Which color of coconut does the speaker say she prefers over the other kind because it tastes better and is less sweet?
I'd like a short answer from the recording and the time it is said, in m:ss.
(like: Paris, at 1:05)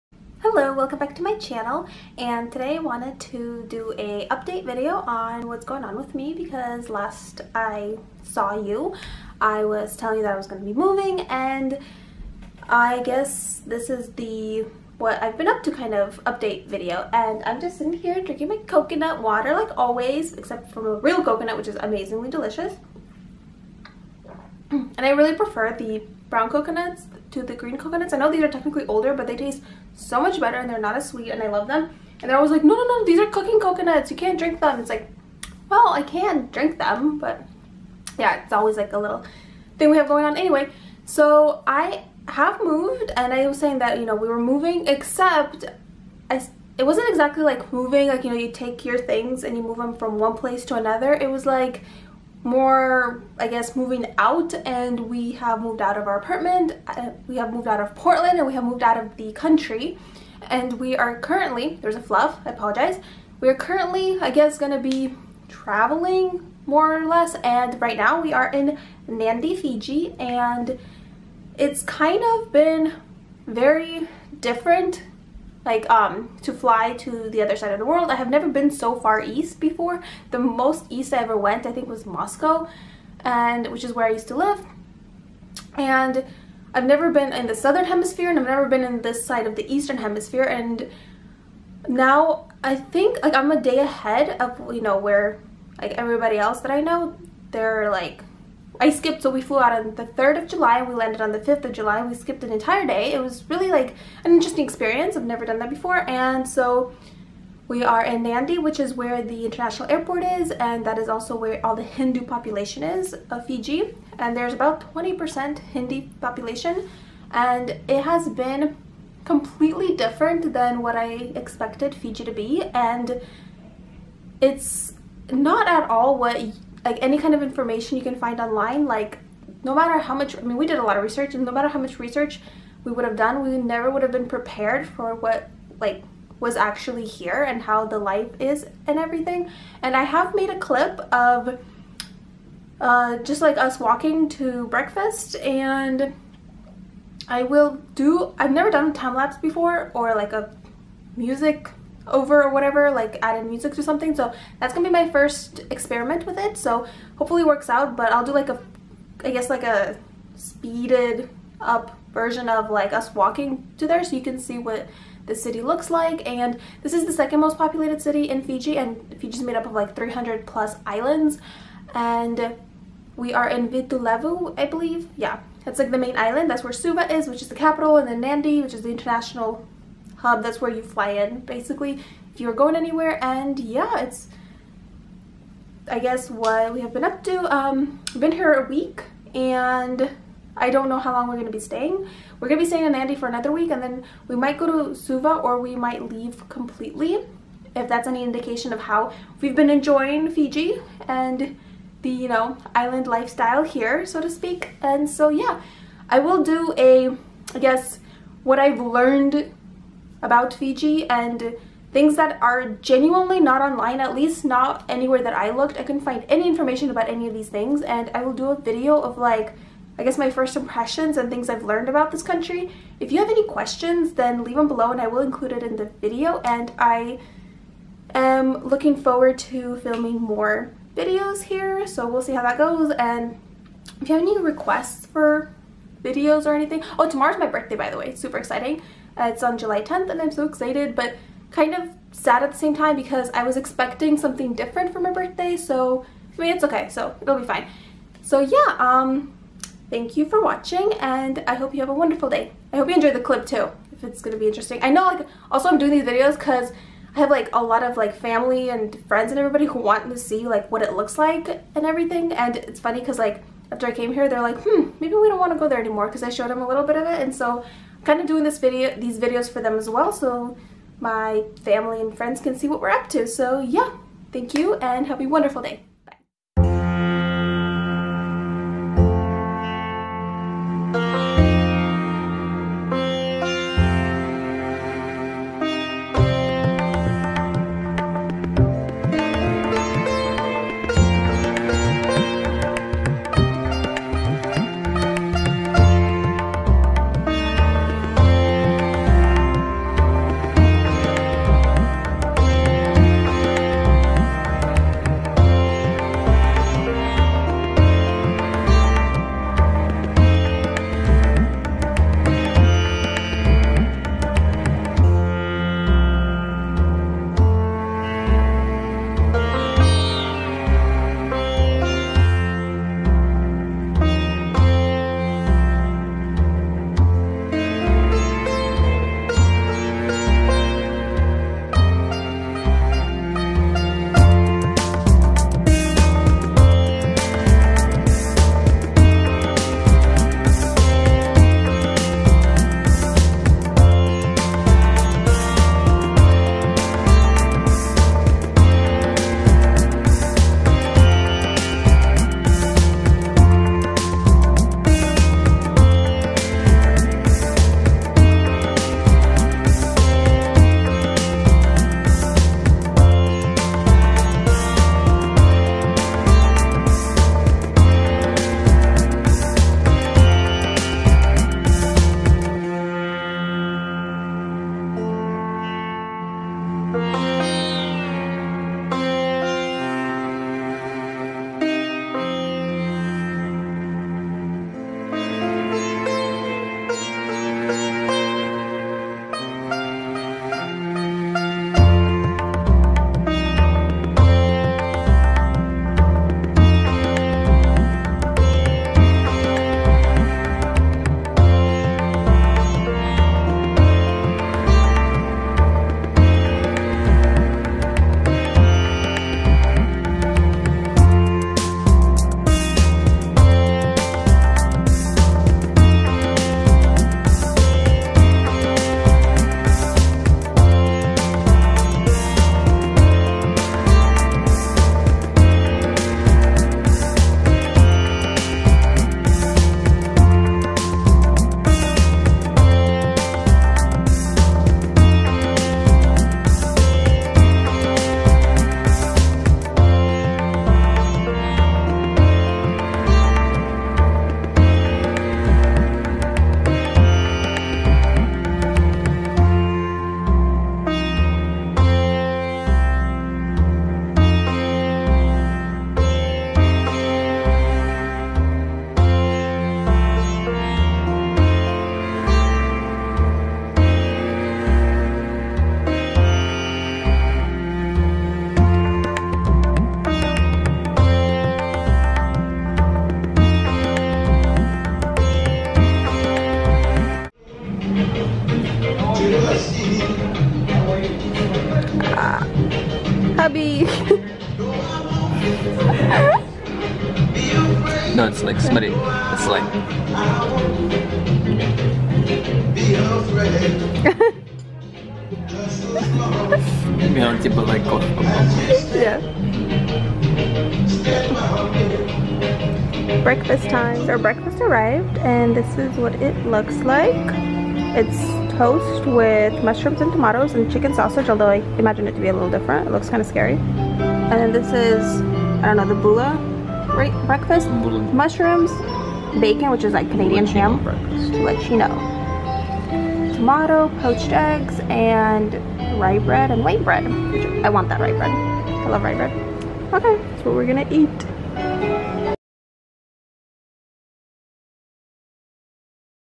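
Brown, at 0:26.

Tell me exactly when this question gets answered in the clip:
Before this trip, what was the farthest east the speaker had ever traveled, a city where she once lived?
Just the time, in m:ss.
1:22.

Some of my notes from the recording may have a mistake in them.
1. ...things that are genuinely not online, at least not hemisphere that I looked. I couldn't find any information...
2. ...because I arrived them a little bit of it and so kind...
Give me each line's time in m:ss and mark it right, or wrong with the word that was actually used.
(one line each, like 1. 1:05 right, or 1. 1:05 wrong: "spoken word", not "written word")
1. 3:31 wrong: "anywhere", not "hemisphere"
2. 4:26 wrong: "showed", not "arrived".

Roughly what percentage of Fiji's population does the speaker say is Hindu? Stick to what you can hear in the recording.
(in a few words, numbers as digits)
20%.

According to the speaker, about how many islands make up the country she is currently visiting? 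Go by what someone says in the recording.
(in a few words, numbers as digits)
300 plus.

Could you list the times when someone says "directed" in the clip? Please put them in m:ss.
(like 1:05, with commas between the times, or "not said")
not said.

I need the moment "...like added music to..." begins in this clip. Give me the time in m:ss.
2:32.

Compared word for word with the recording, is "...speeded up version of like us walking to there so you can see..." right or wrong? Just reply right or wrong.
right.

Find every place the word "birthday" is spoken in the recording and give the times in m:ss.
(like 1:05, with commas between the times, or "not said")
3:57, 4:05.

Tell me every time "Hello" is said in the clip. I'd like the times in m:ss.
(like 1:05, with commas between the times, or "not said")
0:00.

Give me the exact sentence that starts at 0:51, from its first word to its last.
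It was like more, I guess, moving out and we have moved out of our apartment.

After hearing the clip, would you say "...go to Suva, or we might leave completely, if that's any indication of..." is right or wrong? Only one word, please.
right.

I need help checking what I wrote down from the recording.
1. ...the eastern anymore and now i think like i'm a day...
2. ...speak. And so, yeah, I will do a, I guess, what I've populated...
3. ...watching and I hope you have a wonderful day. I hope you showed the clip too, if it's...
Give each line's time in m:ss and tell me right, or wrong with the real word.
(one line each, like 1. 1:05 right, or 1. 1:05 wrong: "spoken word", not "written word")
1. 1:29 wrong: "hemisphere", not "anymore"
2. 3:24 wrong: "learned", not "populated"
3. 4:10 wrong: "enjoyed", not "showed".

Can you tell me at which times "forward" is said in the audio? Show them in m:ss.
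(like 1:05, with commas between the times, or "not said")
3:48.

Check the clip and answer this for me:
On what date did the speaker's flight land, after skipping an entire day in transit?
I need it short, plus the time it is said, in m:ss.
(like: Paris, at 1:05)
5th of July, at 1:41.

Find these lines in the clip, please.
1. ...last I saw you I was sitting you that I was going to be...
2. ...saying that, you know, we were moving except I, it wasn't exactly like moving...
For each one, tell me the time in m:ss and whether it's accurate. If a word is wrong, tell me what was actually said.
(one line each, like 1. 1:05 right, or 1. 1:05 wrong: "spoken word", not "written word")
1. 0:06 wrong: "telling", not "sitting"
2. 0:43 right.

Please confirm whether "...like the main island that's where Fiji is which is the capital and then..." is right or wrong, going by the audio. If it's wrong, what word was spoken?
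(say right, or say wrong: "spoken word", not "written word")
wrong: "Suva", not "Fiji".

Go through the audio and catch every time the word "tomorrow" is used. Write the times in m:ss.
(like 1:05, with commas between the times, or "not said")
3:57.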